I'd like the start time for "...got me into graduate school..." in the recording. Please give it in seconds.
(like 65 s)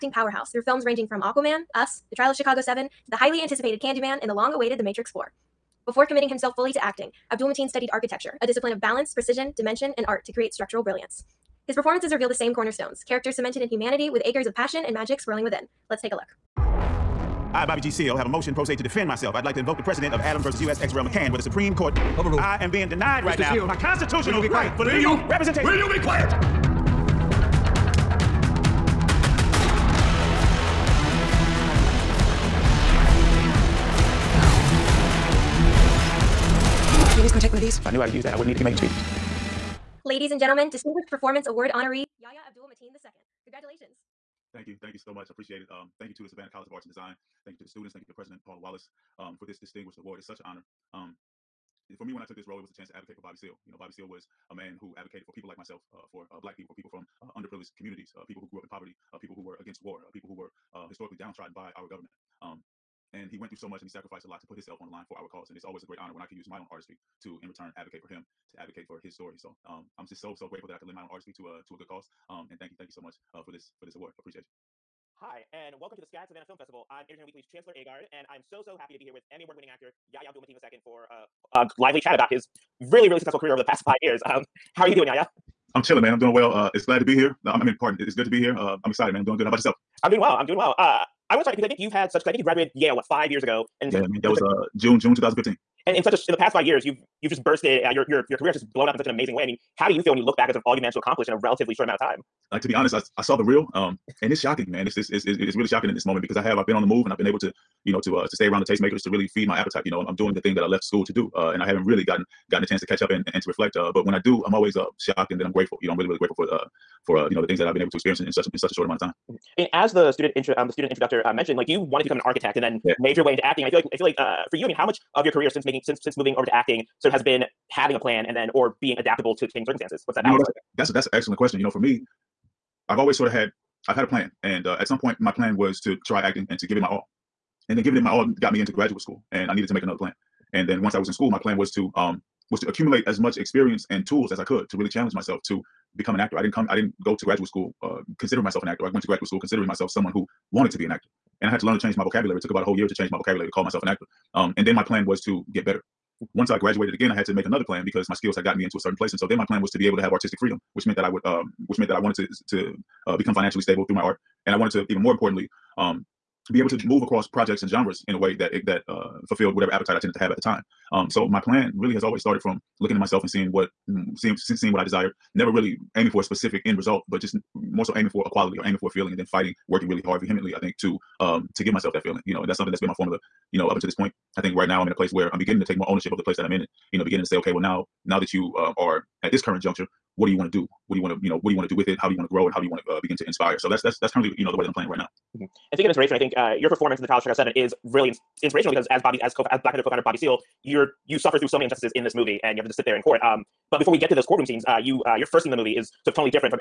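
138 s.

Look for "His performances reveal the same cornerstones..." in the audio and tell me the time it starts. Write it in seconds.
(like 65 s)
11 s.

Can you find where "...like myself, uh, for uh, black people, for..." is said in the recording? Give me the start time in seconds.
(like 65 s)
55 s.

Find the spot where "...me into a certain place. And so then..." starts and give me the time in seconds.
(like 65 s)
158 s.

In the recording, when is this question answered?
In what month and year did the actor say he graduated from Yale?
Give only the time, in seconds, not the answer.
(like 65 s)
94 s.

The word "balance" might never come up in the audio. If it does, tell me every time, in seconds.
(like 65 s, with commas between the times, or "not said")
8 s, 130 s.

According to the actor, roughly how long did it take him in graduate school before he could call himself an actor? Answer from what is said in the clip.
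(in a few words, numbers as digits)
About a whole year.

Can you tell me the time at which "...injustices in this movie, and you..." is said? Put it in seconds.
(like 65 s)
201 s.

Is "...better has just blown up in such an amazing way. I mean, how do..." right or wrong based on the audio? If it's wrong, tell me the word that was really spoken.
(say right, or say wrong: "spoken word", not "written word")
wrong: "career", not "better".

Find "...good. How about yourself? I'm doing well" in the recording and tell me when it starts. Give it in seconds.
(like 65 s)
89 s.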